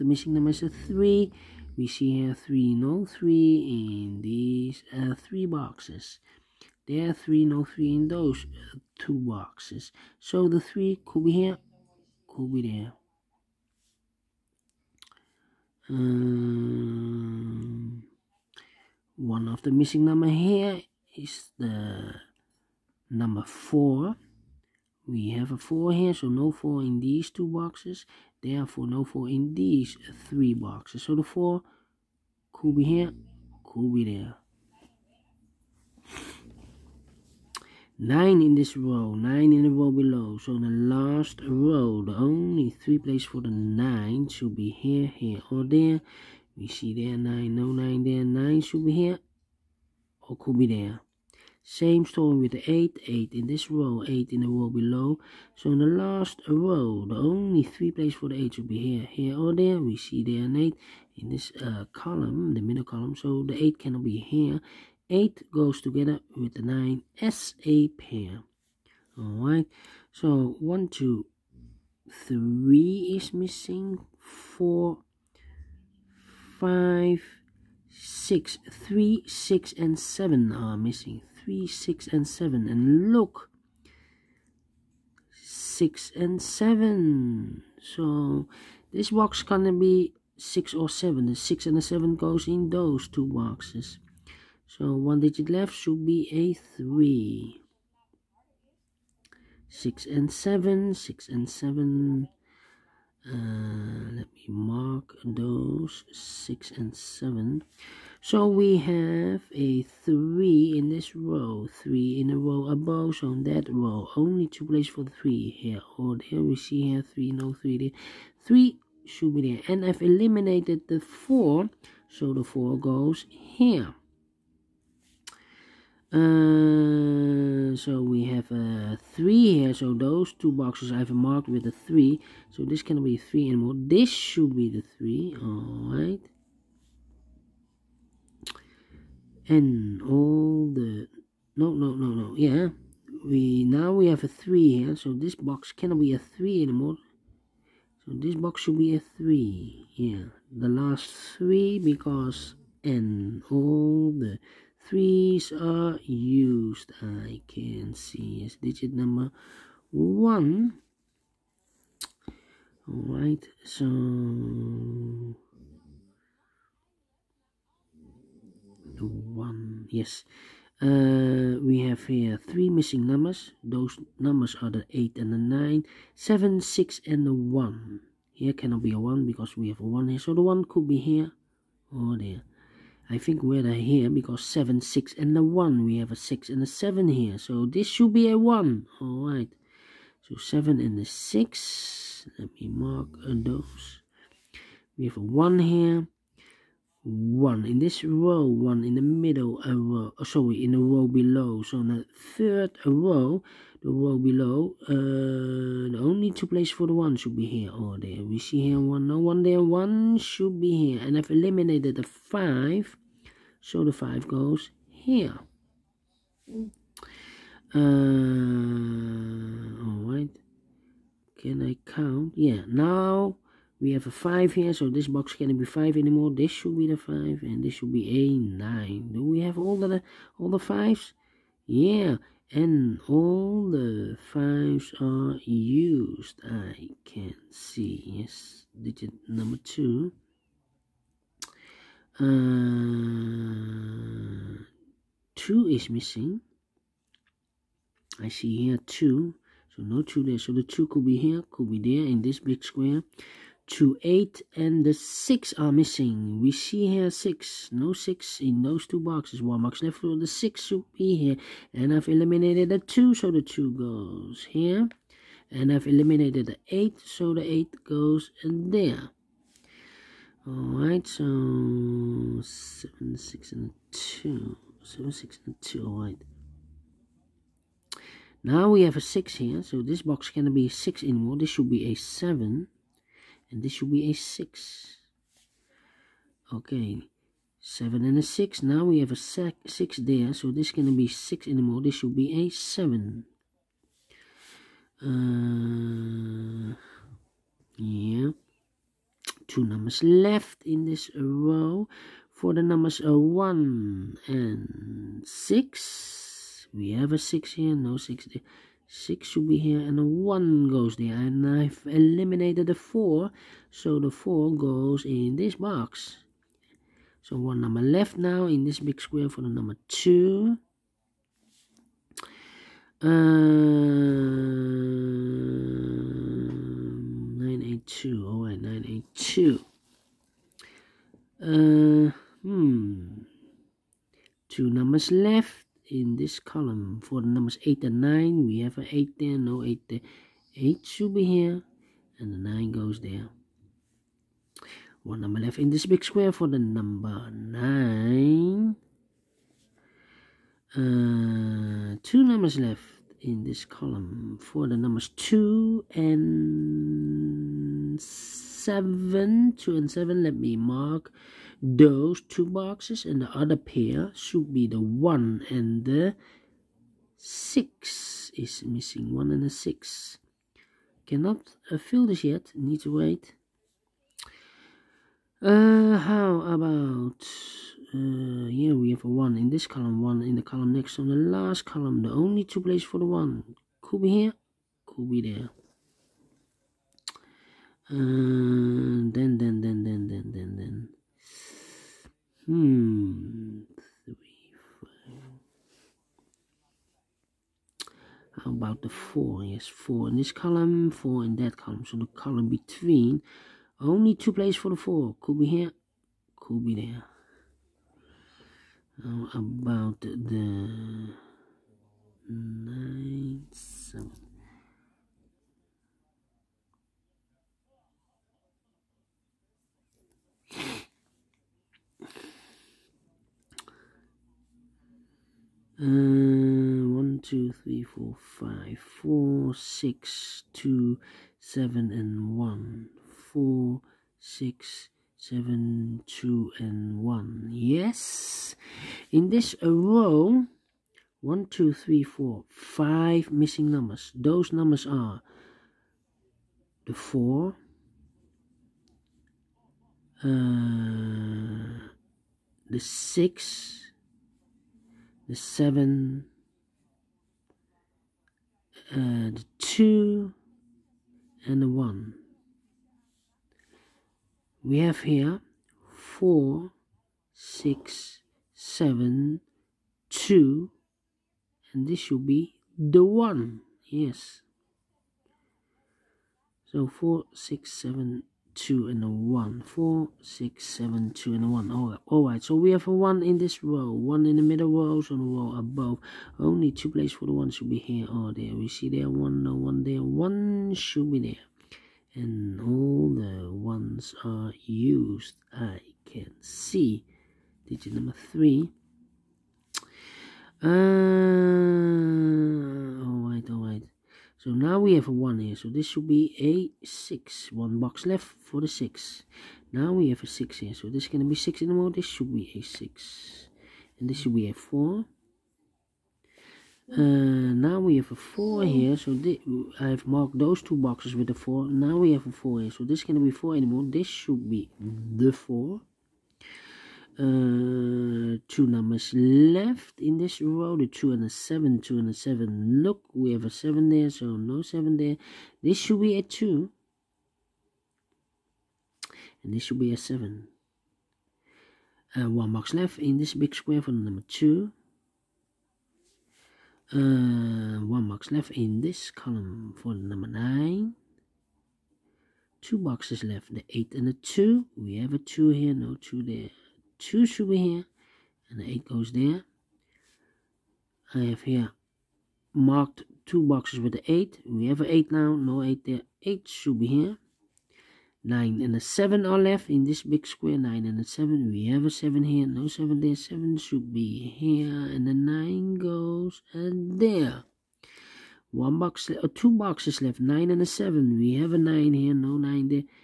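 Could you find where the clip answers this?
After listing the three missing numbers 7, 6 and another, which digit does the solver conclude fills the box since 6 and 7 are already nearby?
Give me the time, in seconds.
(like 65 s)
187 s.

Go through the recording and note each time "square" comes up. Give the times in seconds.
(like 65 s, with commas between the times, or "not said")
252 s, 319 s, 346 s, 543 s, 570 s.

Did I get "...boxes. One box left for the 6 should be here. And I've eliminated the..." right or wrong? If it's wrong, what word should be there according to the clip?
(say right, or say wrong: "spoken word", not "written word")
right.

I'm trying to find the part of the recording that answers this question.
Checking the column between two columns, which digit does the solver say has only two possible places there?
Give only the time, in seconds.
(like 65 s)
403 s.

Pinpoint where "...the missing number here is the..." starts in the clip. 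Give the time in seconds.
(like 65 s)
19 s.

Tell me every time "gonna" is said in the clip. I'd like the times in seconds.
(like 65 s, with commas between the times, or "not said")
89 s, 290 s.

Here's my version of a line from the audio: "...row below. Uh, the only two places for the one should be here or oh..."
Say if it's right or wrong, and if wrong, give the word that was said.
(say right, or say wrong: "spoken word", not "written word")
right.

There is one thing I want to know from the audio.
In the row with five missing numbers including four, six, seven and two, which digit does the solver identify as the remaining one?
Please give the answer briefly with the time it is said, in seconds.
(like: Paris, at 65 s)
1, at 471 s.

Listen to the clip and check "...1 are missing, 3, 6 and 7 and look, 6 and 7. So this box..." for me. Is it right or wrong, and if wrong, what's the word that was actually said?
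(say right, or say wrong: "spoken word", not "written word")
wrong: "7", not "1".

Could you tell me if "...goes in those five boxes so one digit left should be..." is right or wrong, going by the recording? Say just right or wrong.
wrong.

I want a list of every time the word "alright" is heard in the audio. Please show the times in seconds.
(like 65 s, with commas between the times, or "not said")
69 s, 135 s, 162 s, 189 s, 270 s, 275 s.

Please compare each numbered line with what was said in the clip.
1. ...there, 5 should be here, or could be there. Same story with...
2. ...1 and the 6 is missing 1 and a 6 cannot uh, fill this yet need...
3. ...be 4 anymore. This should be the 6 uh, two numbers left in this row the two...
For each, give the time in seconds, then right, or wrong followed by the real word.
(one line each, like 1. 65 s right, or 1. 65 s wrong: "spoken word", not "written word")
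1. 48 s wrong: "9", not "5"
2. 364 s right
3. 523 s wrong: "4", not "6".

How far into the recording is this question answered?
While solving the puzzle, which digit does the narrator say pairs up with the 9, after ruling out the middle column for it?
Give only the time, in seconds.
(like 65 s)
65 s.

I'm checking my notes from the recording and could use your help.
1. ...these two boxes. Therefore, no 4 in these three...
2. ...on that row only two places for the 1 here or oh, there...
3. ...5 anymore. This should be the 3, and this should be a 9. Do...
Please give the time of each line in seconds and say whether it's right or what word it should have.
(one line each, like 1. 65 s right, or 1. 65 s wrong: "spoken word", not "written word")
1. 26 s right
2. 113 s wrong: "3", not "1"
3. 225 s wrong: "5", not "3".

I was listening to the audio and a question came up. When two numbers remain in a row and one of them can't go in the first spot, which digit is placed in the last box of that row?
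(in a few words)
1.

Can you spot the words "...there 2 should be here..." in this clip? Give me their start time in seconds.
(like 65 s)
556 s.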